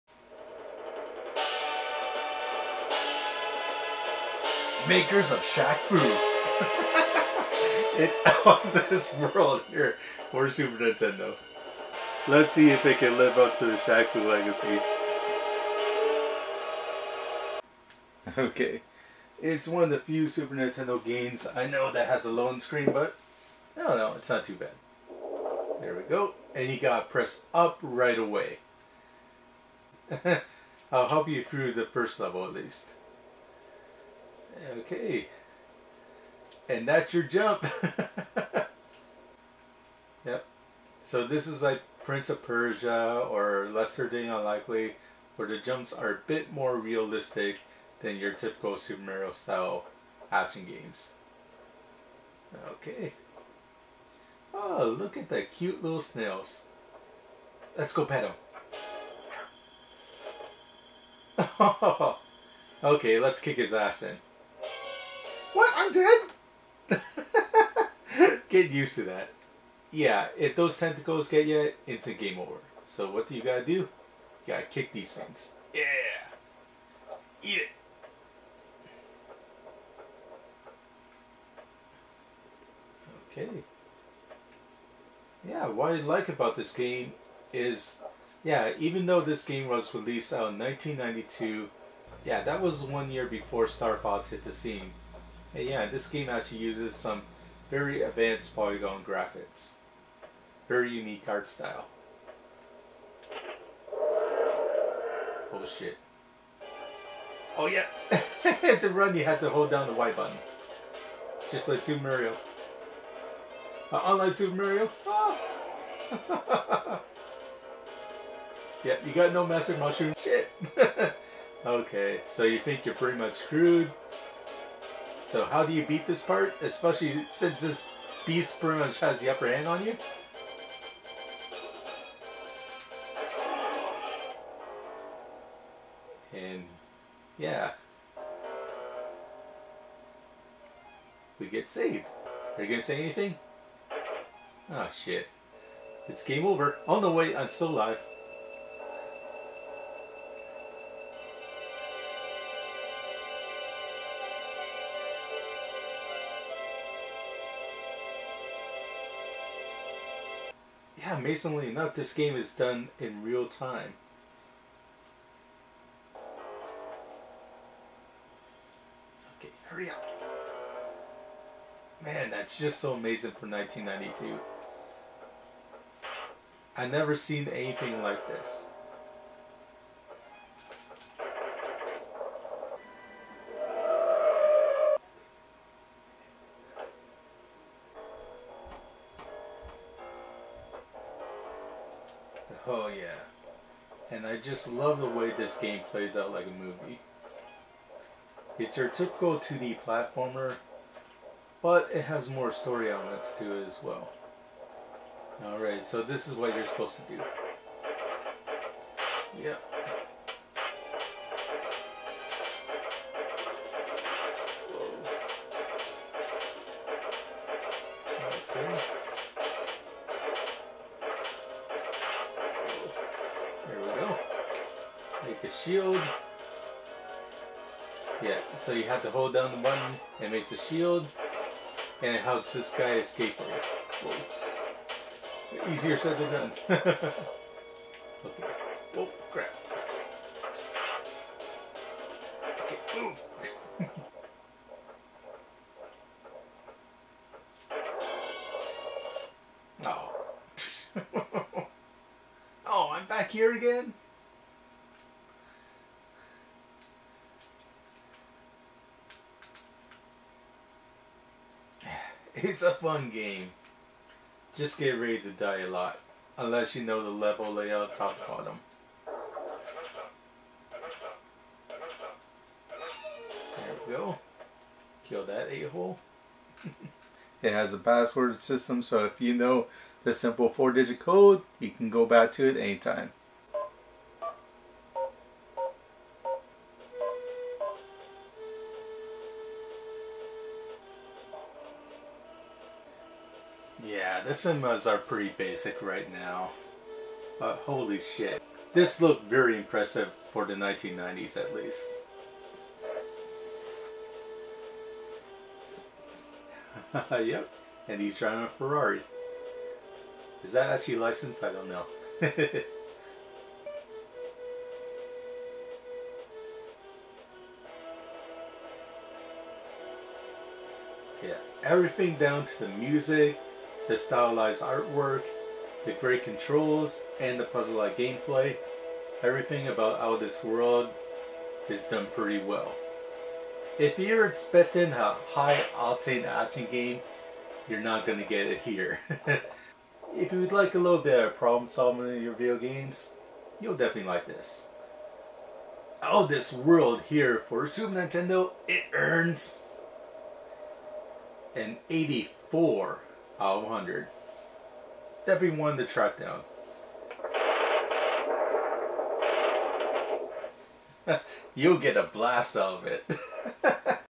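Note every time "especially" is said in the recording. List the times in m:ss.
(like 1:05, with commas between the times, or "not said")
2:06.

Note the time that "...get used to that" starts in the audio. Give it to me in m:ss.
1:08.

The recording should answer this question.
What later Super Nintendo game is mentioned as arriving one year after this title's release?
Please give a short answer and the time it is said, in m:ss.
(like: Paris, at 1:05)
Star Fox, at 1:33.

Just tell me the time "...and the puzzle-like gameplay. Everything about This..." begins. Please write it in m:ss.
5:27.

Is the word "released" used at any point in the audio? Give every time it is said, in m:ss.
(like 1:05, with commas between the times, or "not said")
1:29.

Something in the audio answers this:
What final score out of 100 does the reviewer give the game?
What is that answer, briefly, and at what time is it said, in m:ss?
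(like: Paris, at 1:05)
84, at 5:51.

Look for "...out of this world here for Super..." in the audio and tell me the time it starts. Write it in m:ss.
0:08.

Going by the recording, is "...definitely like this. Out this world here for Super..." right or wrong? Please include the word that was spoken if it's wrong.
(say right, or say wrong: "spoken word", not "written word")
right.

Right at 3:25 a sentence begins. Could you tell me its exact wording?
Alright, so this is what you're supposed to do.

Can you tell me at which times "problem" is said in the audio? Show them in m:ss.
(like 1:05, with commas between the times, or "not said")
5:41.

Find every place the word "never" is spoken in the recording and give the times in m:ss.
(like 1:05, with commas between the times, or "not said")
2:56.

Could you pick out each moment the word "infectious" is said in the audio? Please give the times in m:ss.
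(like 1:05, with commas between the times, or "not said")
not said.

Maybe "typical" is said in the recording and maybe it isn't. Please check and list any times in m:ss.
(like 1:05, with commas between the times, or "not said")
0:48, 3:18.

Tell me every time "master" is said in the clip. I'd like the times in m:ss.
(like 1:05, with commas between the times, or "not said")
1:59.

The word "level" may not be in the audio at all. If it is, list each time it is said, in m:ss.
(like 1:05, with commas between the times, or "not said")
0:32, 4:27.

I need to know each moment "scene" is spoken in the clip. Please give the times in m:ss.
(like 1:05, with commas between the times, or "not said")
1:34.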